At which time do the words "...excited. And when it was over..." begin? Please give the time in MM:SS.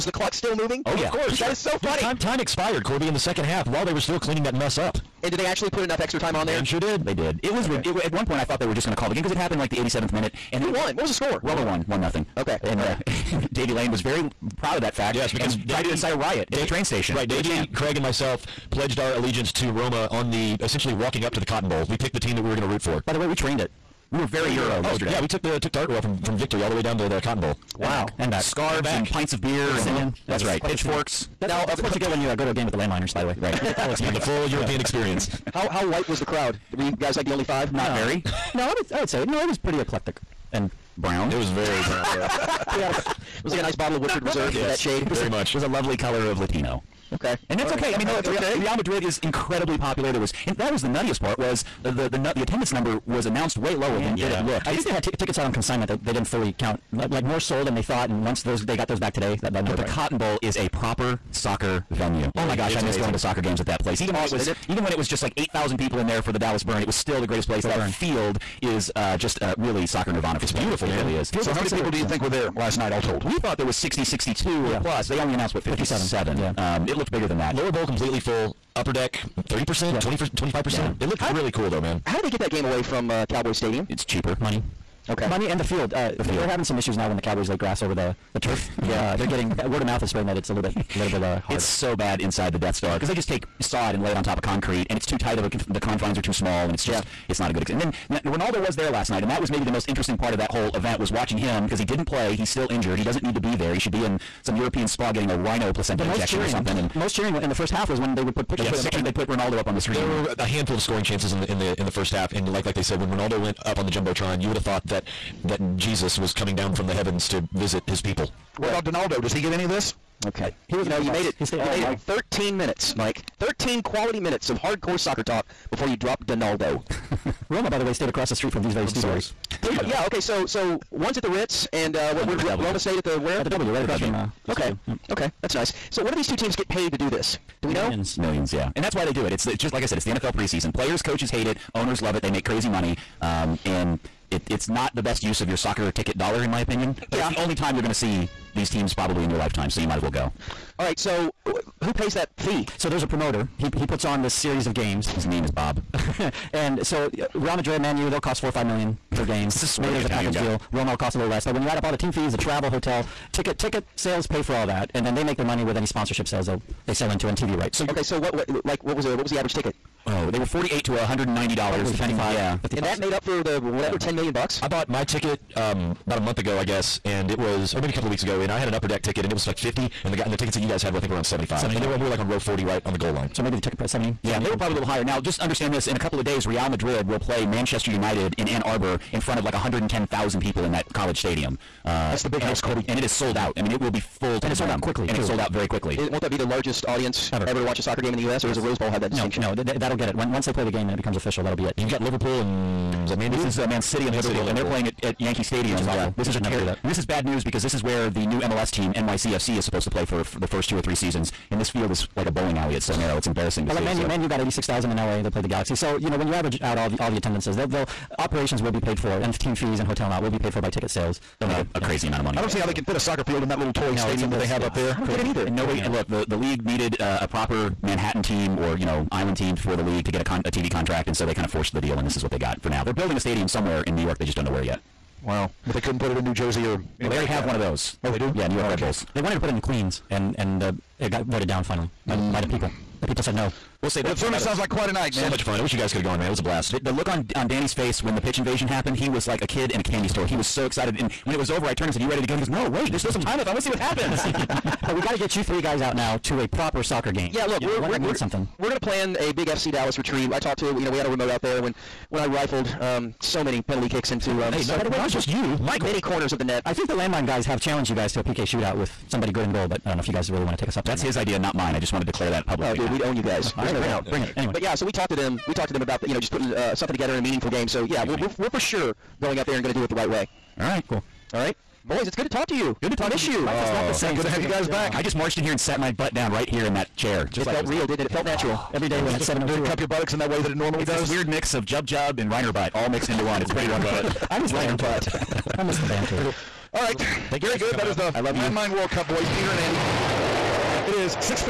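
04:10.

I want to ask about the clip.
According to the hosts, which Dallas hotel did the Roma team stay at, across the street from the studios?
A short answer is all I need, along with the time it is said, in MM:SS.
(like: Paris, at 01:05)
The W, at 02:13.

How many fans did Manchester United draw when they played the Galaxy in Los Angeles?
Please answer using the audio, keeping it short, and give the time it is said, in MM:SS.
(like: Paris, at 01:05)
86,000, at 03:34.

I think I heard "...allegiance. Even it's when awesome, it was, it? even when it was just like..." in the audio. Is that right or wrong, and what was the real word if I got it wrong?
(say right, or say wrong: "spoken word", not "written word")
wrong: "place", not "allegiance".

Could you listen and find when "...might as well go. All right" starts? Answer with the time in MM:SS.
02:29.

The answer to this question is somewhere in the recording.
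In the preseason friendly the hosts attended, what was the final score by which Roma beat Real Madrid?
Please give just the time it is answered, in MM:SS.
00:11.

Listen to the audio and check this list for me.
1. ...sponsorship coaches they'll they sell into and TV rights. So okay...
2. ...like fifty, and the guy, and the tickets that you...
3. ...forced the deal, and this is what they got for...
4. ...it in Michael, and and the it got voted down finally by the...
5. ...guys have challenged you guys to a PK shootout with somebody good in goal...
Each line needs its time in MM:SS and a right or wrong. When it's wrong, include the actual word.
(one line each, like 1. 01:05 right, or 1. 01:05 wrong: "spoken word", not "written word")
1. 02:45 wrong: "sales", not "coaches"
2. 02:59 right
3. 03:51 right
4. 03:59 wrong: "Queens", not "Michael"
5. 04:27 right.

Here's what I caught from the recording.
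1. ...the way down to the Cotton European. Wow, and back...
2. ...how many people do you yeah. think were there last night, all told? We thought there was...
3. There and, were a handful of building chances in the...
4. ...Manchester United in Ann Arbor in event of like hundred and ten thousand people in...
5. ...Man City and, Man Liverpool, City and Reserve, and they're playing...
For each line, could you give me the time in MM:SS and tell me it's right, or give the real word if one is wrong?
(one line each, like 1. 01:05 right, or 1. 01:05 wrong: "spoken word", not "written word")
1. 00:26 wrong: "Bowl", not "European"
2. 01:11 right
3. 01:49 wrong: "scoring", not "building"
4. 03:07 wrong: "front", not "event"
5. 03:23 wrong: "Liverpool", not "Reserve".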